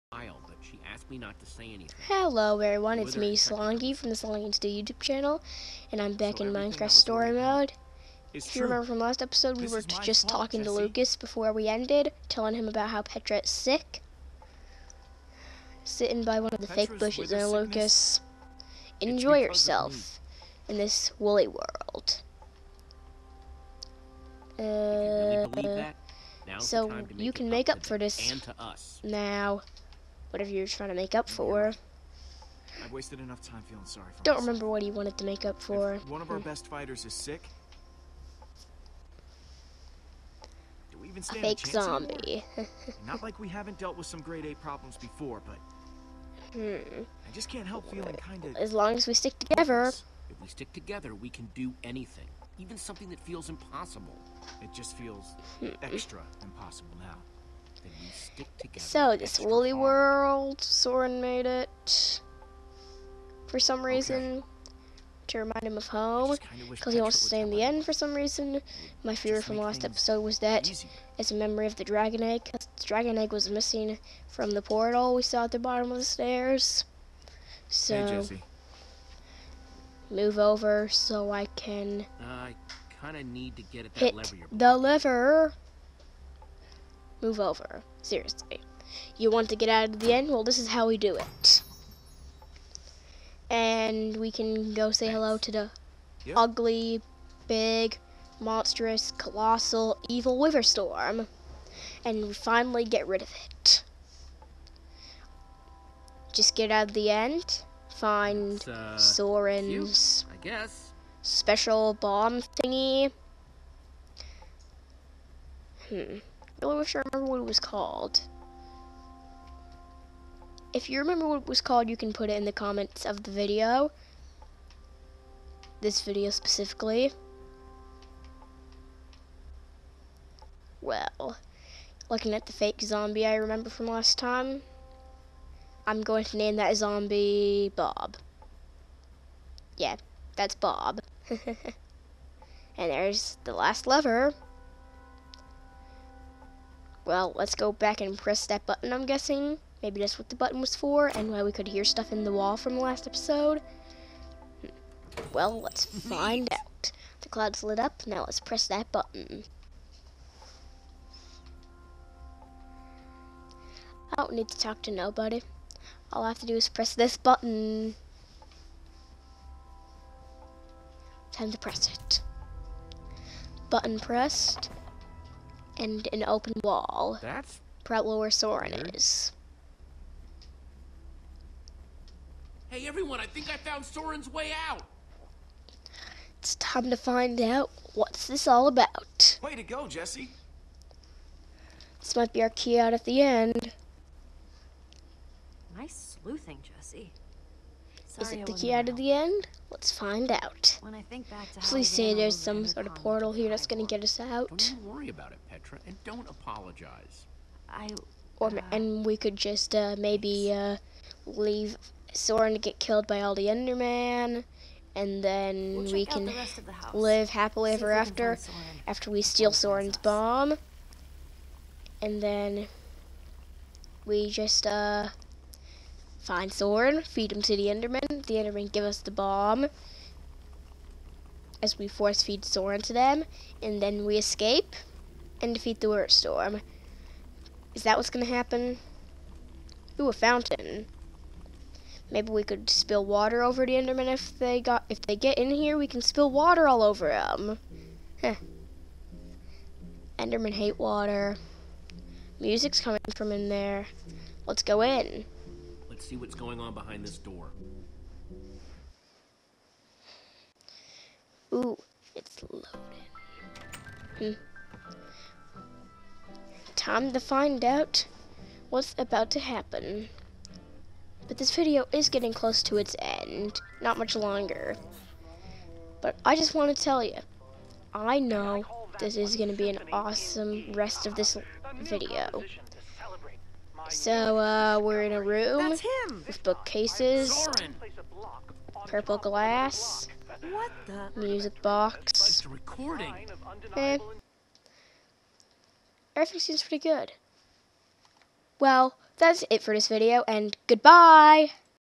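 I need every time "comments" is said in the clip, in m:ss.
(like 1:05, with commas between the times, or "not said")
2:02.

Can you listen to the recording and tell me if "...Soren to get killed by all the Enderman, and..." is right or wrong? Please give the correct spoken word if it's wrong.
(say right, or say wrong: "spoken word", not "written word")
right.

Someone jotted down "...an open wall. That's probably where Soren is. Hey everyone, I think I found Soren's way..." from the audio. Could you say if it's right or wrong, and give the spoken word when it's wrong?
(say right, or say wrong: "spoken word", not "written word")
right.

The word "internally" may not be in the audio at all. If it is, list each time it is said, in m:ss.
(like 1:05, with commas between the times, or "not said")
not said.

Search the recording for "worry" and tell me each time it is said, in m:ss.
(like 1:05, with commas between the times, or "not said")
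3:24.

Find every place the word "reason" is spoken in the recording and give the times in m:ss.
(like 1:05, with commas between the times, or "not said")
1:03, 1:08.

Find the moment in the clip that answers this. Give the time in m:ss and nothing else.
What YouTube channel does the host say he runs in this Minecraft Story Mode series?
0:04.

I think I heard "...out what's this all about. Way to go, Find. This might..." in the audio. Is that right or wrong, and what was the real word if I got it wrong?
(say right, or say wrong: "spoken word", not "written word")
wrong: "Jesse", not "Find".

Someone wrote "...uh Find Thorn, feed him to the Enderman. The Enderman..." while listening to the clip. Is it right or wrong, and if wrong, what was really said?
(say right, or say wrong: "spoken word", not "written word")
right.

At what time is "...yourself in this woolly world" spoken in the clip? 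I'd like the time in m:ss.
0:19.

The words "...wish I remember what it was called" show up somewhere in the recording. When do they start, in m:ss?
1:56.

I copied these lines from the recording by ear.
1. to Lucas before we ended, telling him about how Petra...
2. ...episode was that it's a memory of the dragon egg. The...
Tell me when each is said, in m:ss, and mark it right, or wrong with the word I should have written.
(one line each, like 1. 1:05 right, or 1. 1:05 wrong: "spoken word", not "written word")
1. 0:10 right
2. 1:09 right.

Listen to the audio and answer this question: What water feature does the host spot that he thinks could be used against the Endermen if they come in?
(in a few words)
A fountain.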